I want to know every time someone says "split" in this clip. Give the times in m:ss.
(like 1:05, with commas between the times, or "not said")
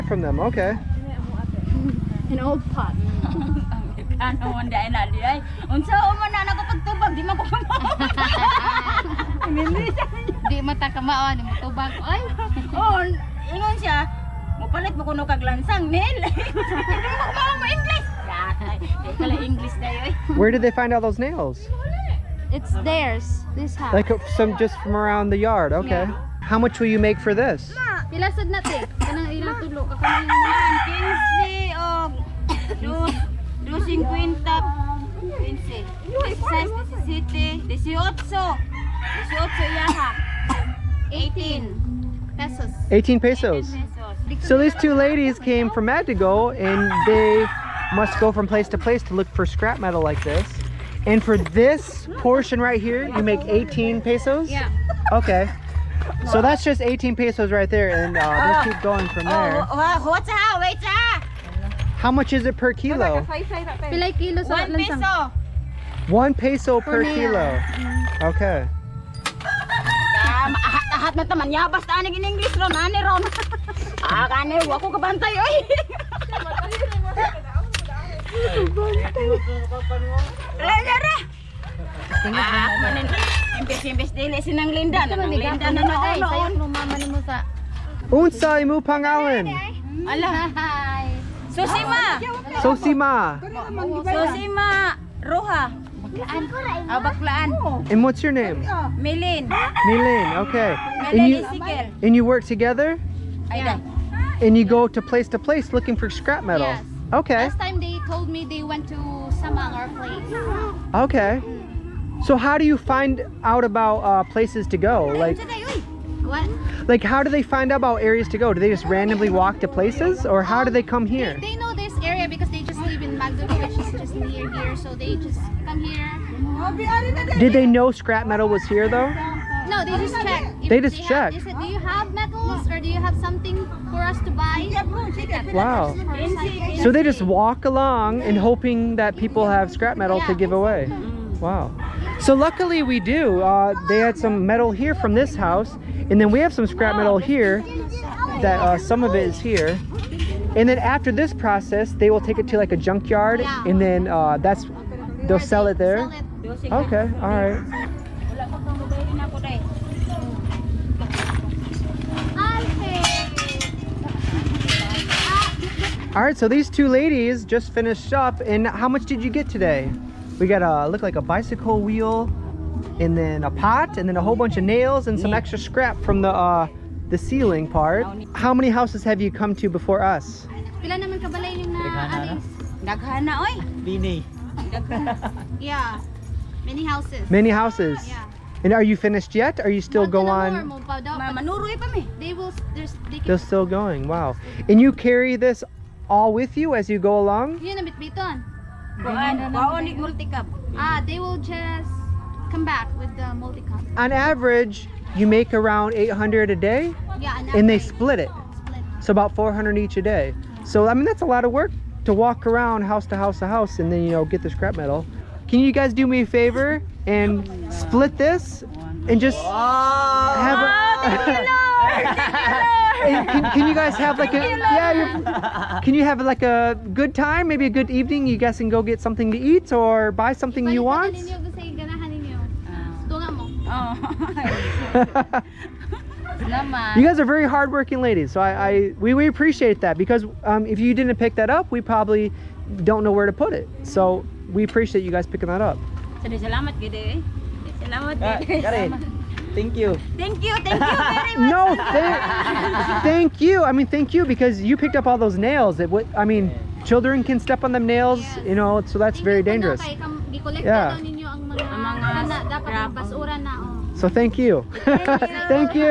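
3:27, 3:37.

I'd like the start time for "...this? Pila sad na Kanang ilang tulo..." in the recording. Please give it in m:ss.
0:27.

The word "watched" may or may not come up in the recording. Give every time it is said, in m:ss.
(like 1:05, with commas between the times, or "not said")
not said.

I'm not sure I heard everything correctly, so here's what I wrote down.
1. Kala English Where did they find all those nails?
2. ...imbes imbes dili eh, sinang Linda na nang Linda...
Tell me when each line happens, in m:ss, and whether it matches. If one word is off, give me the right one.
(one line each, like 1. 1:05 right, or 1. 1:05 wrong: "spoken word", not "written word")
1. 0:19 right
2. 1:23 right.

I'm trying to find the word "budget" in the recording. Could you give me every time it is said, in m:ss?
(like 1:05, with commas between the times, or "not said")
not said.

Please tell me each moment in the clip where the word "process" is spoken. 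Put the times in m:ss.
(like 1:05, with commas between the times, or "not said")
2:31.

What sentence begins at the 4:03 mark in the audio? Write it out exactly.
So we appreciate you guys picking that up.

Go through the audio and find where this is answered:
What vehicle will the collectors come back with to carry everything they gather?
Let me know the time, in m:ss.
3:23.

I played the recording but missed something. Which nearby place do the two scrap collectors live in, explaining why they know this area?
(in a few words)
Magdalene.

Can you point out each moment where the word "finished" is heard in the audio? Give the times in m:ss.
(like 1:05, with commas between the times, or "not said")
2:47, 3:08.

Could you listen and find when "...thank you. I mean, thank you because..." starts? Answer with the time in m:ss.
4:13.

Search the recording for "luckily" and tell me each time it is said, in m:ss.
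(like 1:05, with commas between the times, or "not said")
2:22.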